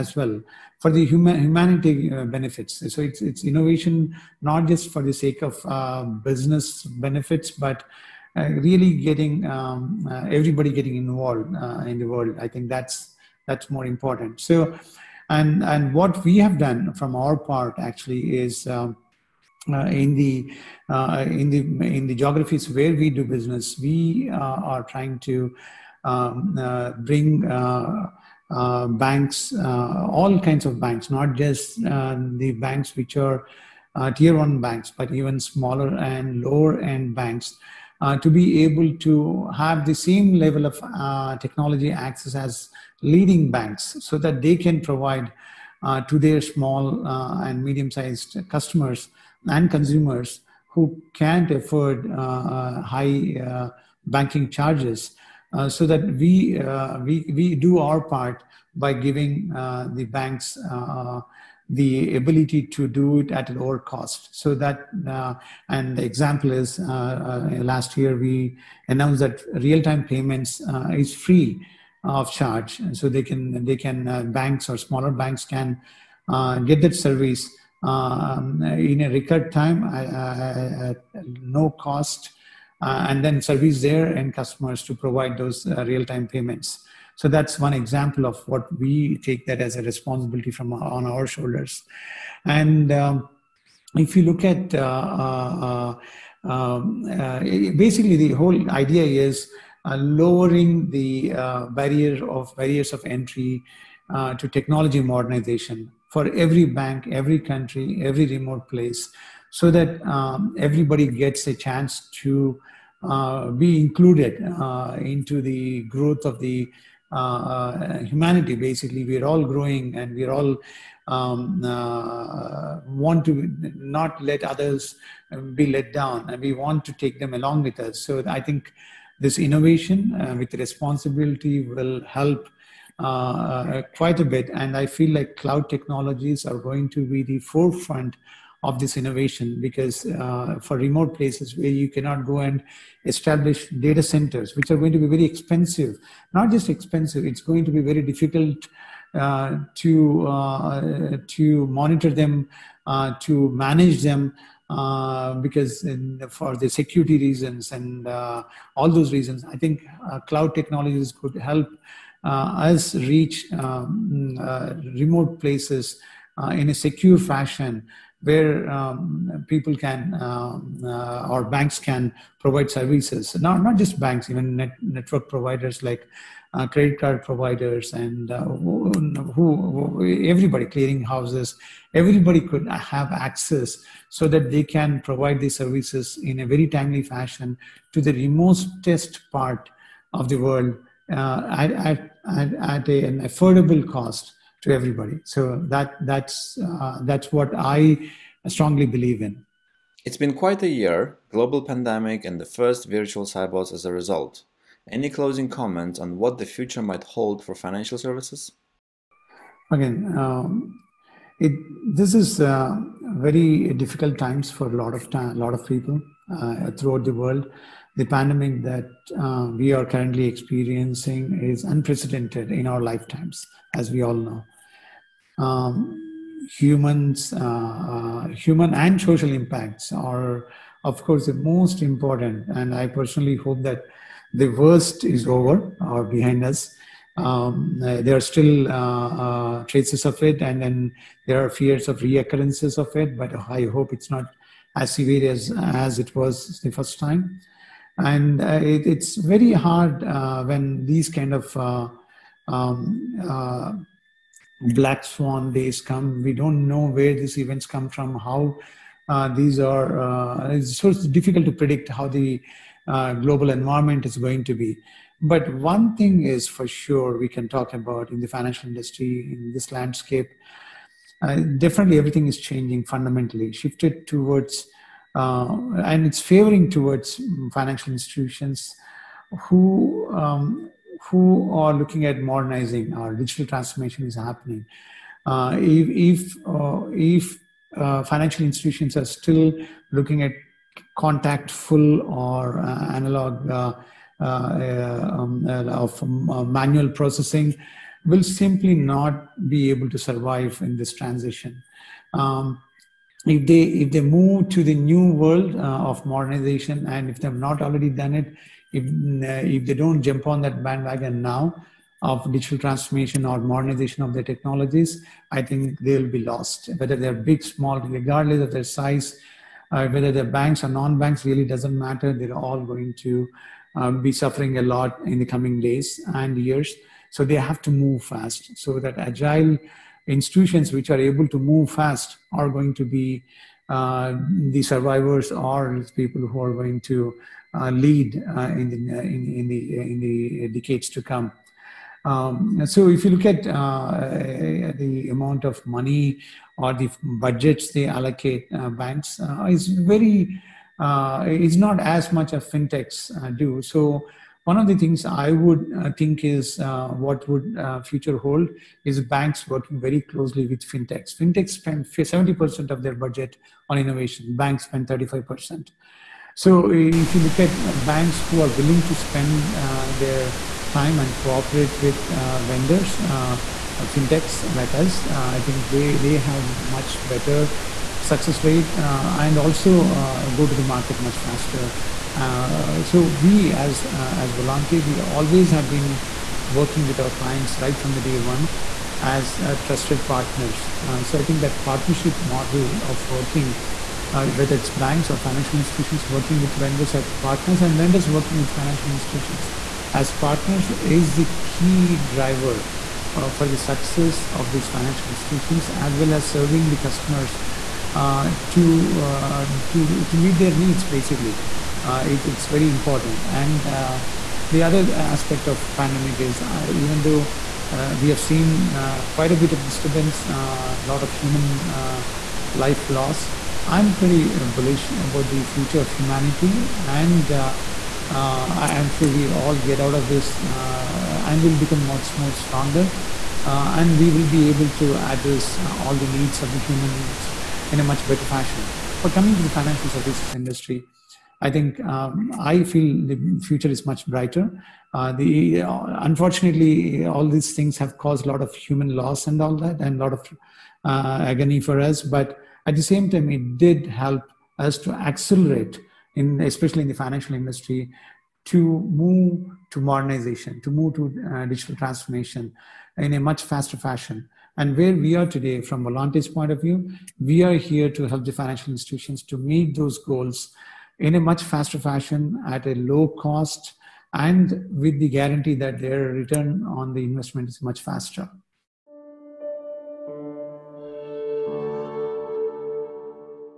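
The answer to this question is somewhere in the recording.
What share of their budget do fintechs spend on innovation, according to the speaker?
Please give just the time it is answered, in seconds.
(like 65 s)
361 s.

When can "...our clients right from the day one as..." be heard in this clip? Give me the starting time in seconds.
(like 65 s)
386 s.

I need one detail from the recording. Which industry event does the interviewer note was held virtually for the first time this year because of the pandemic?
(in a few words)
Sibos.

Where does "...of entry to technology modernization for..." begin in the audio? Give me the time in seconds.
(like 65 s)
102 s.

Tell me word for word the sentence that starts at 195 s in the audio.
So that that's uh, that's what I strongly believe in.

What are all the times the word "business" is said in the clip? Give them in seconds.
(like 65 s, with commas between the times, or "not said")
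6 s, 23 s.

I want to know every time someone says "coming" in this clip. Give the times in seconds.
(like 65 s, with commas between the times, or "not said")
325 s, 439 s.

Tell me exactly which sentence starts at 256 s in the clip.
We don't know where these events come from, how uh, these are.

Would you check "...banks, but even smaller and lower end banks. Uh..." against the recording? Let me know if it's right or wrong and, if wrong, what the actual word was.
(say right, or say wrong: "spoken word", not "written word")
right.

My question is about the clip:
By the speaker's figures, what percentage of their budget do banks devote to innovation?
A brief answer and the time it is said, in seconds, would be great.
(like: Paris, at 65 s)
35%, at 364 s.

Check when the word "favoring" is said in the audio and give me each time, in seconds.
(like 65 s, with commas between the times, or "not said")
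276 s.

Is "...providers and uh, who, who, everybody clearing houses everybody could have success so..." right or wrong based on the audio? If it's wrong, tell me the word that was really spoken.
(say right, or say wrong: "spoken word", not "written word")
wrong: "access", not "success".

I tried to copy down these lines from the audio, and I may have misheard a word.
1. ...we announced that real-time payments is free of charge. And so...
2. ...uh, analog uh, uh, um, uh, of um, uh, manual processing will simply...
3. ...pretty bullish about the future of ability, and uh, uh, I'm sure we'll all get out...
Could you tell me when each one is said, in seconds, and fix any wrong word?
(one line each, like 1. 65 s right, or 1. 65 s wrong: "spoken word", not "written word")
1. 68 s right
2. 292 s right
3. 423 s wrong: "humanity", not "ability".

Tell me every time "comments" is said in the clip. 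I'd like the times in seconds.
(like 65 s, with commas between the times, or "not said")
205 s.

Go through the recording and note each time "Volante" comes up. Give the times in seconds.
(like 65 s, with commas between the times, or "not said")
384 s, 465 s.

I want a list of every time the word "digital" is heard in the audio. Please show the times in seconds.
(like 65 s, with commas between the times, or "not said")
283 s, 312 s, 461 s.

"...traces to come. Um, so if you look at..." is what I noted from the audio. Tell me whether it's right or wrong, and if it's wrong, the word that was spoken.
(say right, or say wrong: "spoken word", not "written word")
wrong: "decades", not "traces".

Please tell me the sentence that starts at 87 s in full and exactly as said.
So that's one example of what we take that as a responsibility from our, on our shoulders.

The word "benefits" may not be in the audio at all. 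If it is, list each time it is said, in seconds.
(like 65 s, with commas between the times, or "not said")
2 s, 6 s.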